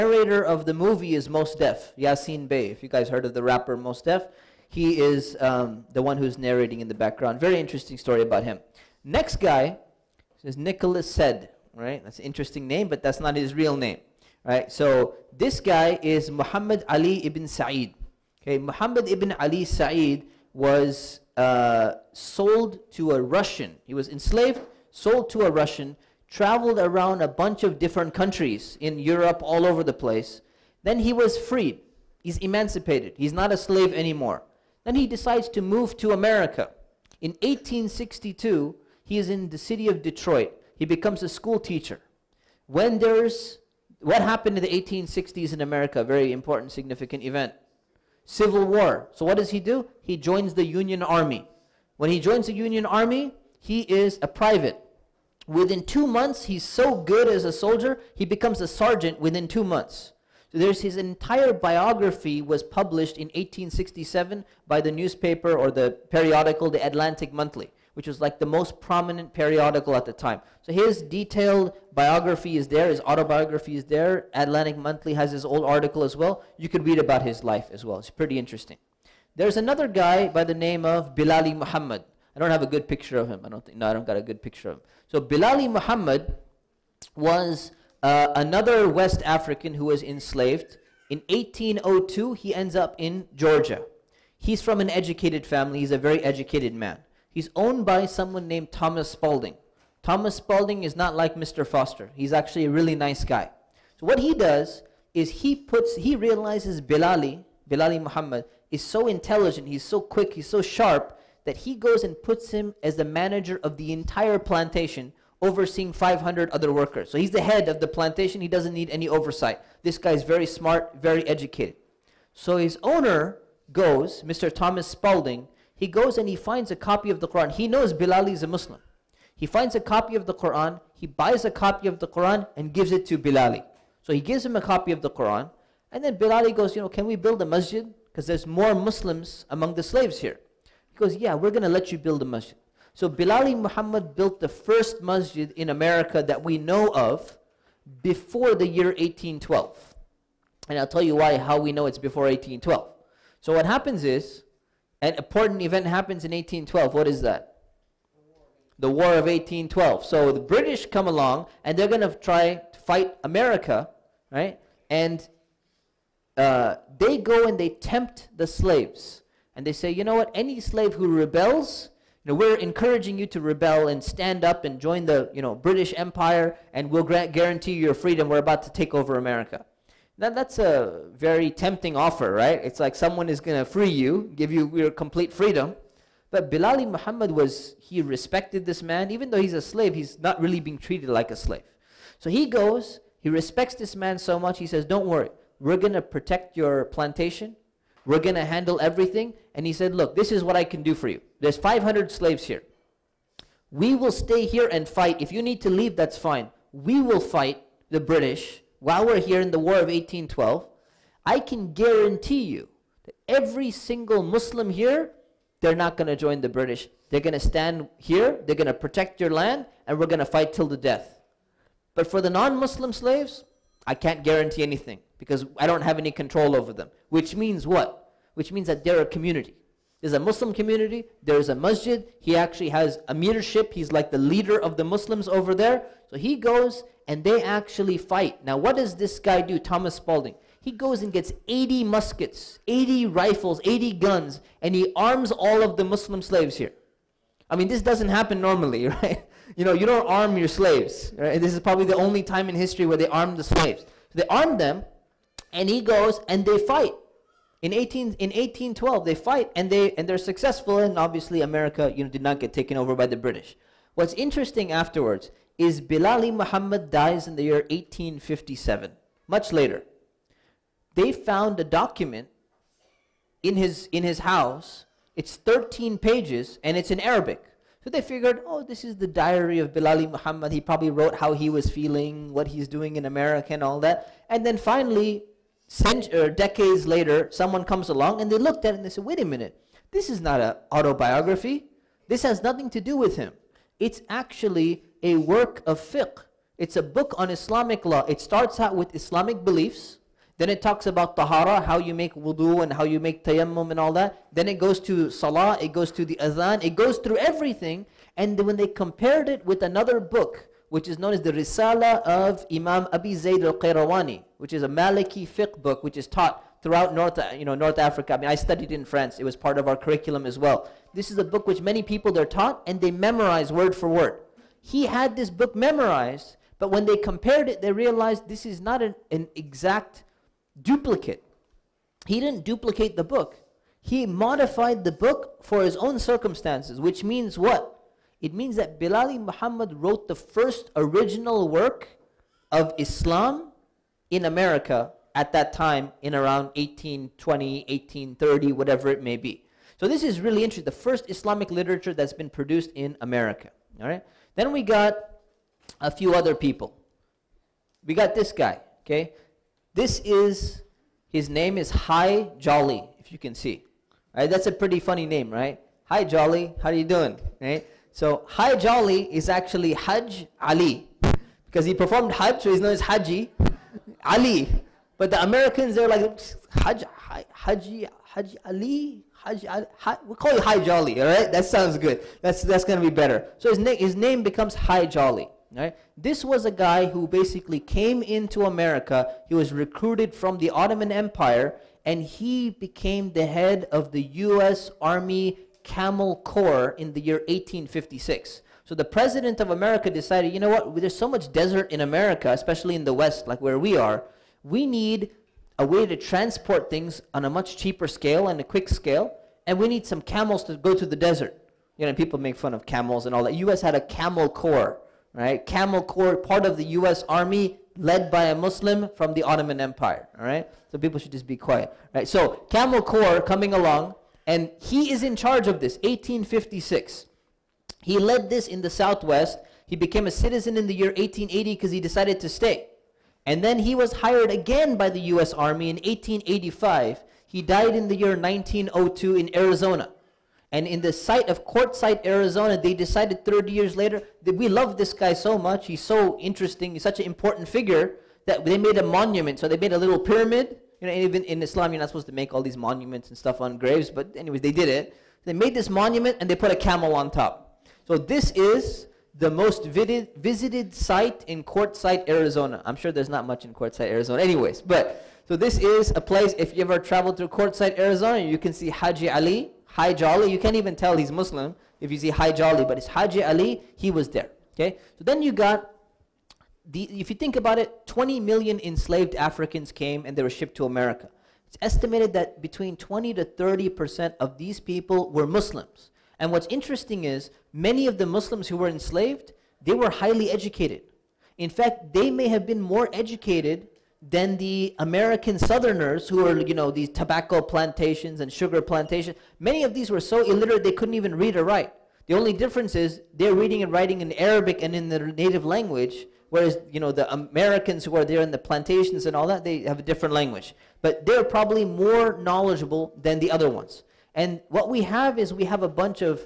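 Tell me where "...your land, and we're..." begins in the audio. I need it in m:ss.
3:39.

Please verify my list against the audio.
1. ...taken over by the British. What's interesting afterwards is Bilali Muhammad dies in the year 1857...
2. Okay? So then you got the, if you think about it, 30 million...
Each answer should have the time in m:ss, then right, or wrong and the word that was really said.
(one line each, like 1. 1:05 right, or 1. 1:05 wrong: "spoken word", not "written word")
1. 4:22 right
2. 7:54 wrong: "20", not "30".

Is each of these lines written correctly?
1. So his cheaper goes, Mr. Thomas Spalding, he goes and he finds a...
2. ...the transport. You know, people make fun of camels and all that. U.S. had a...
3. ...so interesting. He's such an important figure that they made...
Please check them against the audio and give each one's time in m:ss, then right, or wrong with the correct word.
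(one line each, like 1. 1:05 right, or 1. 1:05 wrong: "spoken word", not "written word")
1. 2:02 wrong: "owner", not "cheaper"
2. 6:50 wrong: "desert", not "transport"
3. 7:25 right.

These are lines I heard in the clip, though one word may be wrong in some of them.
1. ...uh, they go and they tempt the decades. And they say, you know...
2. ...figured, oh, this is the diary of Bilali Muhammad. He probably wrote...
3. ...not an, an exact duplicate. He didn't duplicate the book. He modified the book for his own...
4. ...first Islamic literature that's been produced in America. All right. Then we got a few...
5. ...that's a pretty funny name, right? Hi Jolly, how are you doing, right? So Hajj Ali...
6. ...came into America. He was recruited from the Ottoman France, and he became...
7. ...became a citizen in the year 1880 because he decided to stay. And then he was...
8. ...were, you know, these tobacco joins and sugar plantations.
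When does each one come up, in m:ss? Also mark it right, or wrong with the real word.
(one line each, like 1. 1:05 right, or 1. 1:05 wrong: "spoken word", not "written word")
1. 2:46 wrong: "slaves", not "decades"
2. 4:38 right
3. 5:28 right
4. 5:50 right
5. 6:04 right
6. 6:27 wrong: "Empire", not "France"
7. 7:09 right
8. 8:16 wrong: "plantations", not "joins".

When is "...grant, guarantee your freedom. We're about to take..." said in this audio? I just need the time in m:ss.
2:57.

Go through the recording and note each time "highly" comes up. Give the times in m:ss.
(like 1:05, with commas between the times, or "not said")
8:09.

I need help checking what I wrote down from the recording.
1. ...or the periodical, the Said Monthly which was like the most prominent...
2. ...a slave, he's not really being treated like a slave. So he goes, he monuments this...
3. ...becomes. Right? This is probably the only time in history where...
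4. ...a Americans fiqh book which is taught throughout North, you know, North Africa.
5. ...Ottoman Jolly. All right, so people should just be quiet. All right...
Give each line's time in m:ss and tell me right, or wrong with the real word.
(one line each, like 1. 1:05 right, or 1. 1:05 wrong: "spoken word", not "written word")
1. 1:05 wrong: "Atlantic", not "Said"
2. 3:09 wrong: "respects", not "monuments"
3. 4:10 wrong: "slaves", not "becomes"
4. 5:14 wrong: "Maliki", not "Americans"
5. 6:59 wrong: "Empire", not "Jolly".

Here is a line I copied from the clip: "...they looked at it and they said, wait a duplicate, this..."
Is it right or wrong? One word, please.
wrong.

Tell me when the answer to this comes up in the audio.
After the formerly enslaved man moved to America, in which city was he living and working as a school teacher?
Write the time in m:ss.
0:40.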